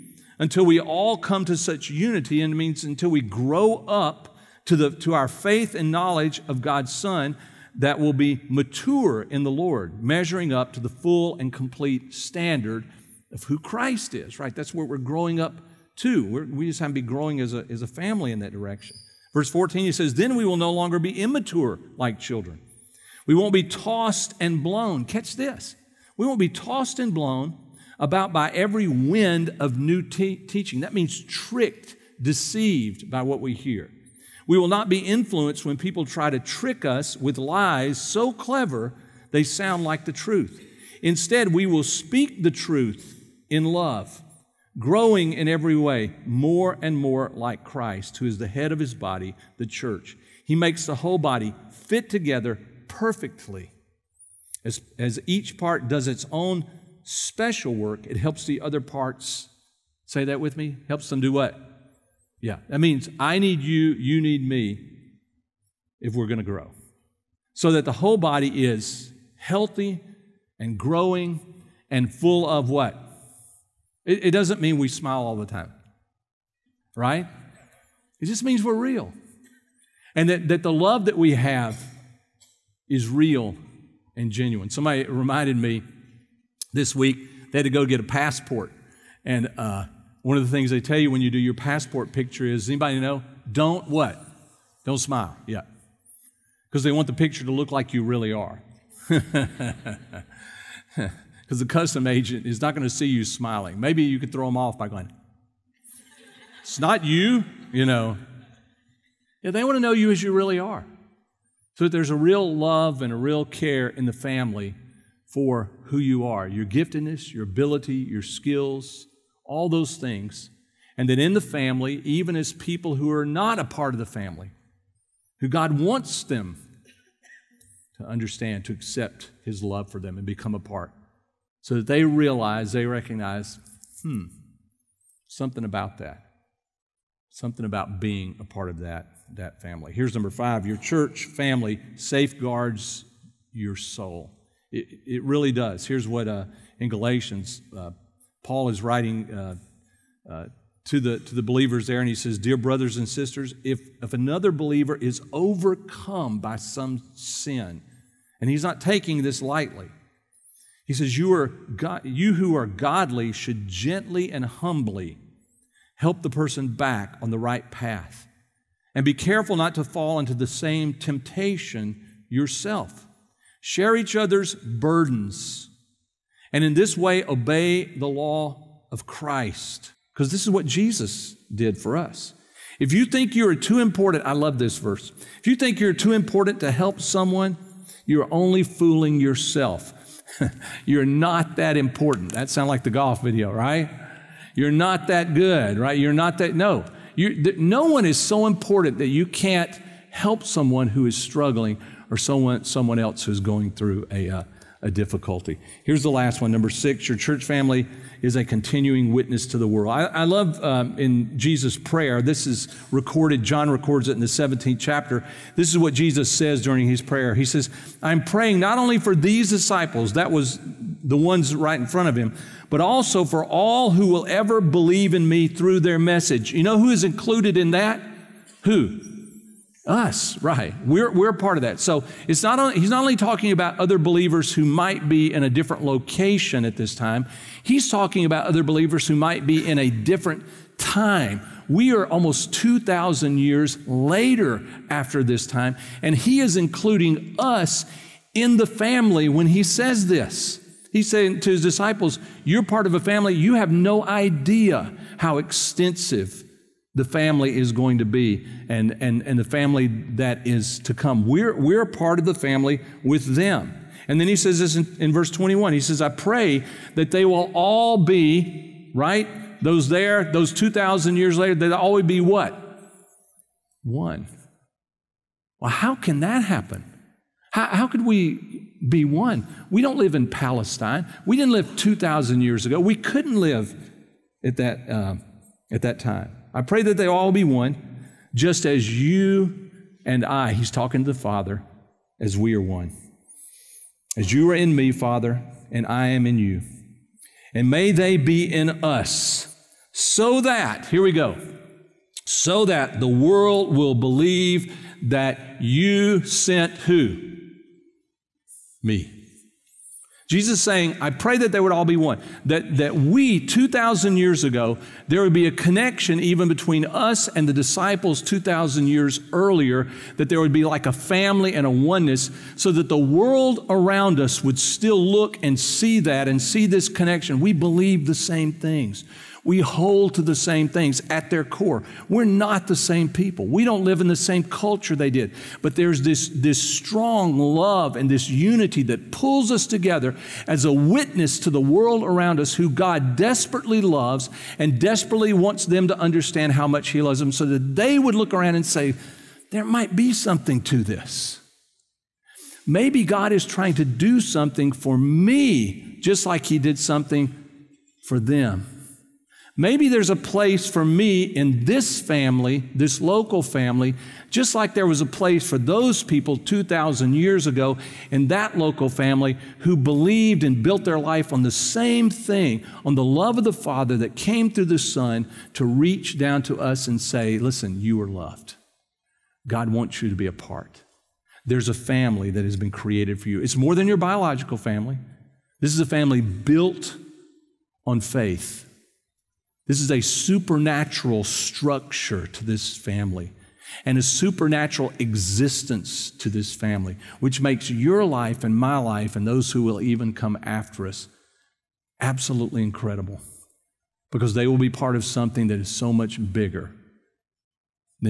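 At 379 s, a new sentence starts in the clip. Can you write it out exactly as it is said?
God wants you to be a part.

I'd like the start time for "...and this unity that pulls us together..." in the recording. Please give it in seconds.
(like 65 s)
337 s.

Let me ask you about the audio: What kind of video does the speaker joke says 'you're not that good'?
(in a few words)
golf video.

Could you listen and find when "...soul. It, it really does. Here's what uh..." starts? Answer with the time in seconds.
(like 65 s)
143 s.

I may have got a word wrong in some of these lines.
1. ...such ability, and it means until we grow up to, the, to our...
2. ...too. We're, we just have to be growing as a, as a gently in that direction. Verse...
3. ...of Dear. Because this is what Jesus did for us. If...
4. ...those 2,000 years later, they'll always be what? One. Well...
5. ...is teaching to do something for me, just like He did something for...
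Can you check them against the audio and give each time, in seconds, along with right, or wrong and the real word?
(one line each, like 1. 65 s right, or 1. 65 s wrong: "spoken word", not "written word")
1. 1 s wrong: "unity", not "ability"
2. 15 s wrong: "family", not "gently"
3. 178 s wrong: "Christ", not "Dear"
4. 270 s right
5. 353 s wrong: "trying", not "teaching".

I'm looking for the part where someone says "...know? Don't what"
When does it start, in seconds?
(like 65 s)
92 s.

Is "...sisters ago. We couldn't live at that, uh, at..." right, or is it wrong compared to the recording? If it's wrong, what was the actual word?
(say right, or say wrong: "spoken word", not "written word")
wrong: "years", not "sisters".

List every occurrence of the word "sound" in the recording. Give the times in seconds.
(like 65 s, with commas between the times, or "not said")
39 s, 192 s.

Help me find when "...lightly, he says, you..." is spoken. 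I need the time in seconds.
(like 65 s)
159 s.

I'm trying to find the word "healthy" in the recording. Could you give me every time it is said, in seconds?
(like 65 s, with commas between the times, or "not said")
69 s.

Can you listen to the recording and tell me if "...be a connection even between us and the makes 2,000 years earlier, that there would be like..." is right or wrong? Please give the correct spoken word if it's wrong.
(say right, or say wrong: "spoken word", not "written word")
wrong: "disciples", not "makes".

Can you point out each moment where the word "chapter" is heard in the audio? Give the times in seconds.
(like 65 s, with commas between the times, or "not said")
214 s.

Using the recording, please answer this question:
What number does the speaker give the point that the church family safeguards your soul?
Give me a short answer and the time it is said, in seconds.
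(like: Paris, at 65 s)
5, at 140 s.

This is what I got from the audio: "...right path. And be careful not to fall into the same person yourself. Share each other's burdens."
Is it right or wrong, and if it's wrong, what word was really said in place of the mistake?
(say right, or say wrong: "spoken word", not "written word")
wrong: "temptation", not "person".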